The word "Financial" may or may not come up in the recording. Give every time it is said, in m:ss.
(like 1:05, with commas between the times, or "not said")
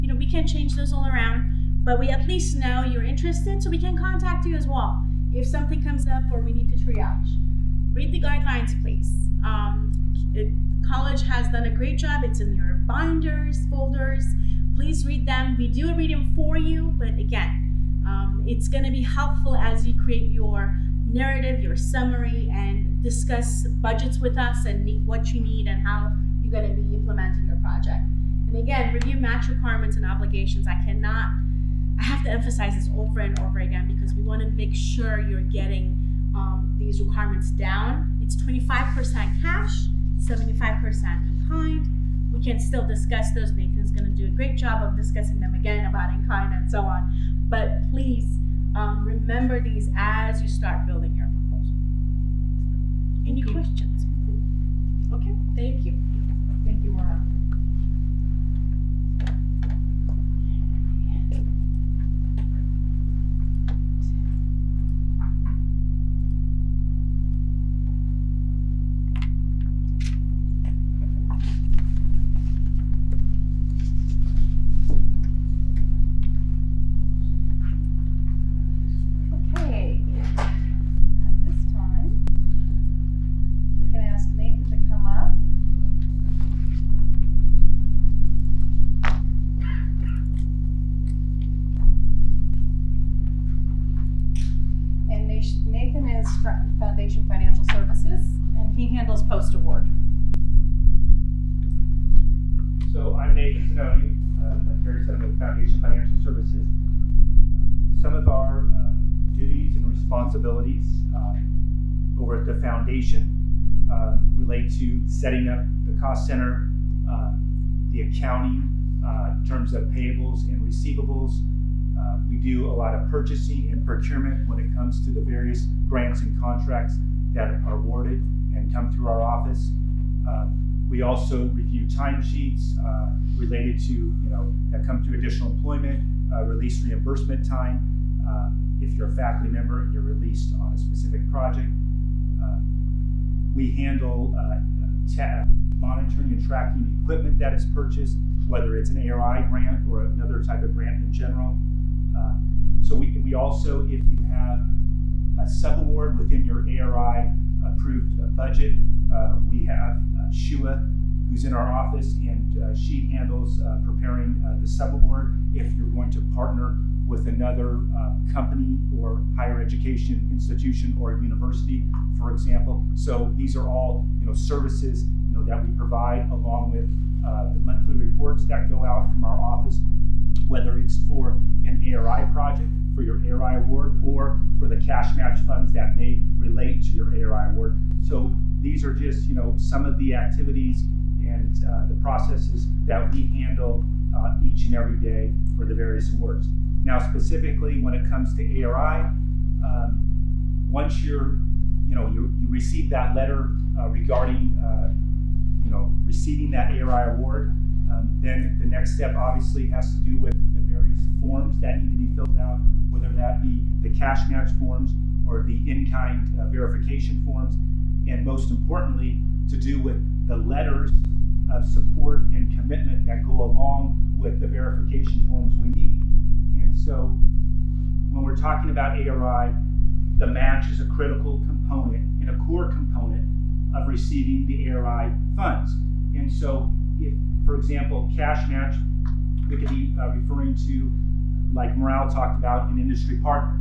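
1:37, 1:45.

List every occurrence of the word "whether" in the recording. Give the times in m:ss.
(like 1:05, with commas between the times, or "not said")
2:28, 3:00, 3:33.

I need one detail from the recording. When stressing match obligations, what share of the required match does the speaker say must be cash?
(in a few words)
25%.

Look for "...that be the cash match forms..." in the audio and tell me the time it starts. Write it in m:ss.
3:33.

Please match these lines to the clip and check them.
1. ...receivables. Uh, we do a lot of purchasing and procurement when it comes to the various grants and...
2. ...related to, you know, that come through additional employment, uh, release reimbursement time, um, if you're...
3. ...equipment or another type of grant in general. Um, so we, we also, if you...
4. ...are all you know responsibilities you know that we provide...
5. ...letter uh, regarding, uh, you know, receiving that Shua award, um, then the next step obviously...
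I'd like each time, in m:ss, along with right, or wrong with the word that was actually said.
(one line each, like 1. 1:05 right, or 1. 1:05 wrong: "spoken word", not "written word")
1. 2:00 right
2. 2:13 right
3. 2:29 wrong: "grant", not "equipment"
4. 2:53 wrong: "services", not "responsibilities"
5. 3:23 wrong: "ARI", not "Shua".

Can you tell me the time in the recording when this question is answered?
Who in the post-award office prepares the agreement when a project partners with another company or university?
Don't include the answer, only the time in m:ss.
2:40.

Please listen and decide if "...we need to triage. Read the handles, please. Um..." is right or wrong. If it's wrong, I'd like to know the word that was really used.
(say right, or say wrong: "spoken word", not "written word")
wrong: "guidelines", not "handles".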